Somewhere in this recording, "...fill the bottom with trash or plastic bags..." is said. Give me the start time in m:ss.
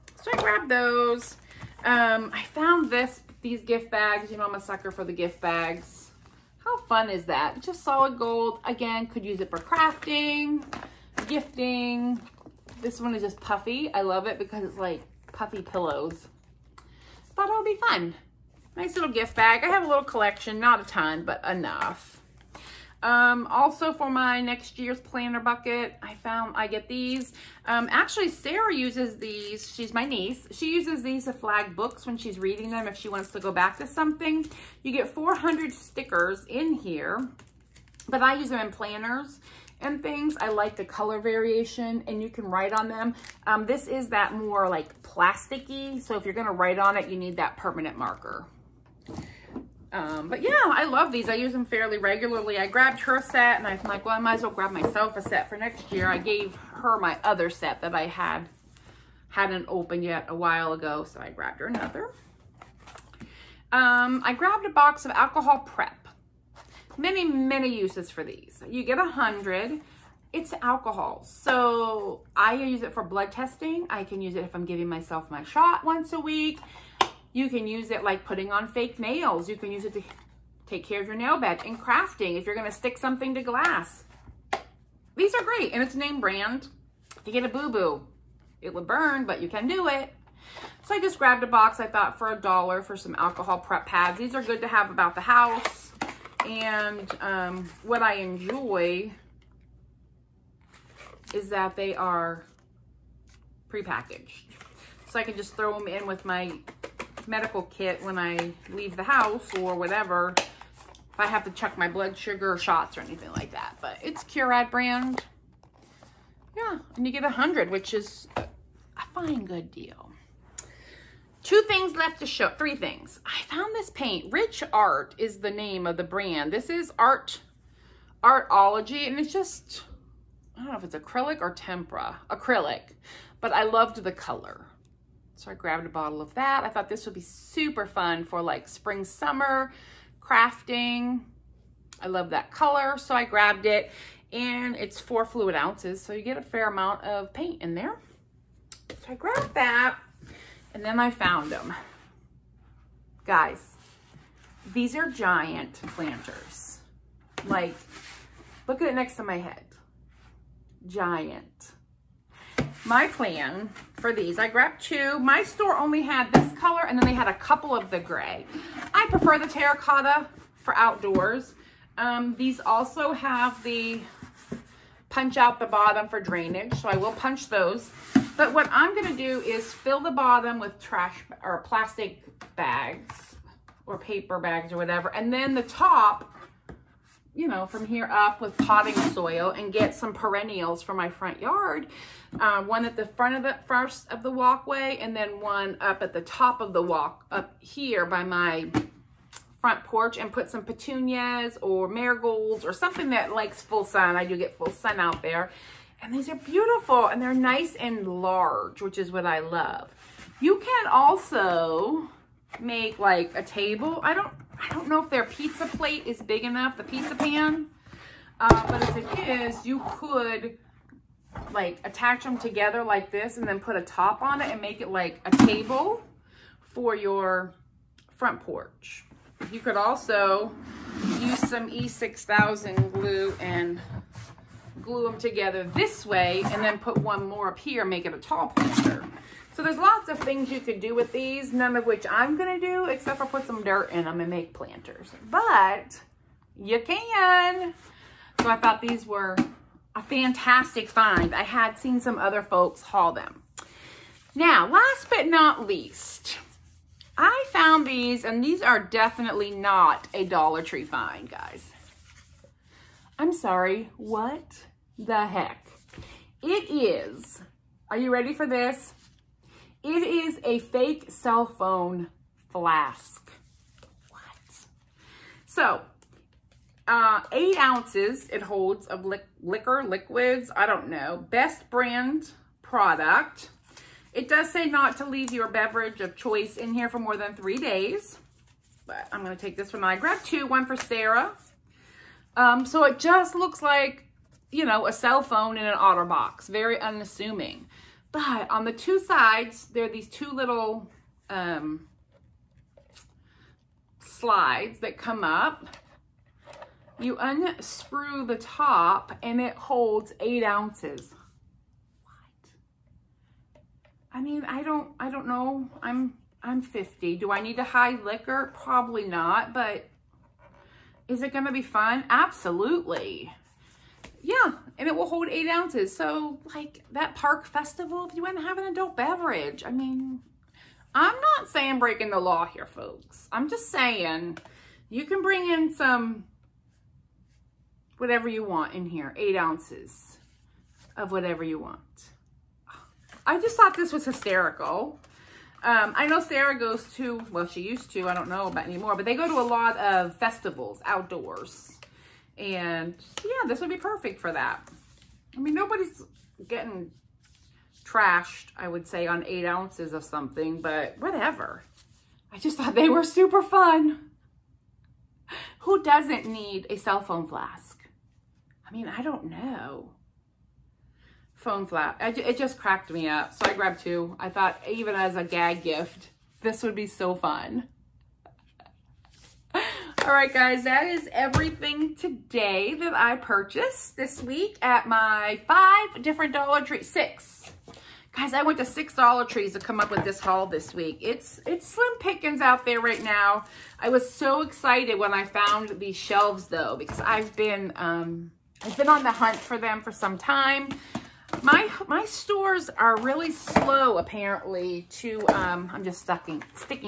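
2:59.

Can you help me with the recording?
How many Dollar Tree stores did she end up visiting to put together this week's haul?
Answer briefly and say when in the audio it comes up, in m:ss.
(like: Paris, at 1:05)
6, at 6:28.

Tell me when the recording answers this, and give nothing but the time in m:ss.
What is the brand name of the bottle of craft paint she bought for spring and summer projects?
2:04.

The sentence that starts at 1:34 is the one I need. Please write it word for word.
These are good to have about the house.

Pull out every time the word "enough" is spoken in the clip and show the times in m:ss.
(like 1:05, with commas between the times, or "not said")
0:21, 3:36.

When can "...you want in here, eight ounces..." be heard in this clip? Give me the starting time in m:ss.
5:38.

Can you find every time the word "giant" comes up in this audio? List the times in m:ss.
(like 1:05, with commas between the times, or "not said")
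2:35, 2:40.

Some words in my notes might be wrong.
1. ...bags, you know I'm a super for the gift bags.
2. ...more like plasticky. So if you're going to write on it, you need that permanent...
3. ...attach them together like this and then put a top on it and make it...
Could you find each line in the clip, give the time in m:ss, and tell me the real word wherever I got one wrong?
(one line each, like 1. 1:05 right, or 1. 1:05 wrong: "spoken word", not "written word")
1. 0:03 wrong: "sucker", not "super"
2. 0:44 right
3. 3:41 right.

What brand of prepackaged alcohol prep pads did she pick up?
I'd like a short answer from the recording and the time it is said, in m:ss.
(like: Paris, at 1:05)
Curad, at 1:54.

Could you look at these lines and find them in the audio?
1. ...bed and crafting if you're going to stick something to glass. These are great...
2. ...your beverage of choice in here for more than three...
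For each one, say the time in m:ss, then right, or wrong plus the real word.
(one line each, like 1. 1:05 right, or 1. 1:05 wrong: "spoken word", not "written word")
1. 1:21 right
2. 4:45 right.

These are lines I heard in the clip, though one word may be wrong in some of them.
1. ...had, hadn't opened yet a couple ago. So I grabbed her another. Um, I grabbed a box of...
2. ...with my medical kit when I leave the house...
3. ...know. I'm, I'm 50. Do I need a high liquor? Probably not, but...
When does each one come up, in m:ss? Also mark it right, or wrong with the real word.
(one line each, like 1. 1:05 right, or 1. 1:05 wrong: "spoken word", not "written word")
1. 0:58 wrong: "while", not "couple"
2. 1:46 right
3. 5:15 right.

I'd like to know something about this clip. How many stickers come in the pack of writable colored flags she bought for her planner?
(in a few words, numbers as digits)
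400.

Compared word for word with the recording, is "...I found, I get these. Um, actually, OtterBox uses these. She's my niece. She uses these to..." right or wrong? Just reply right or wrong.
wrong.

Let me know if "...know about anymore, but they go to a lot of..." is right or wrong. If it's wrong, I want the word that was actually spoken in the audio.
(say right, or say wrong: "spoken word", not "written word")
right.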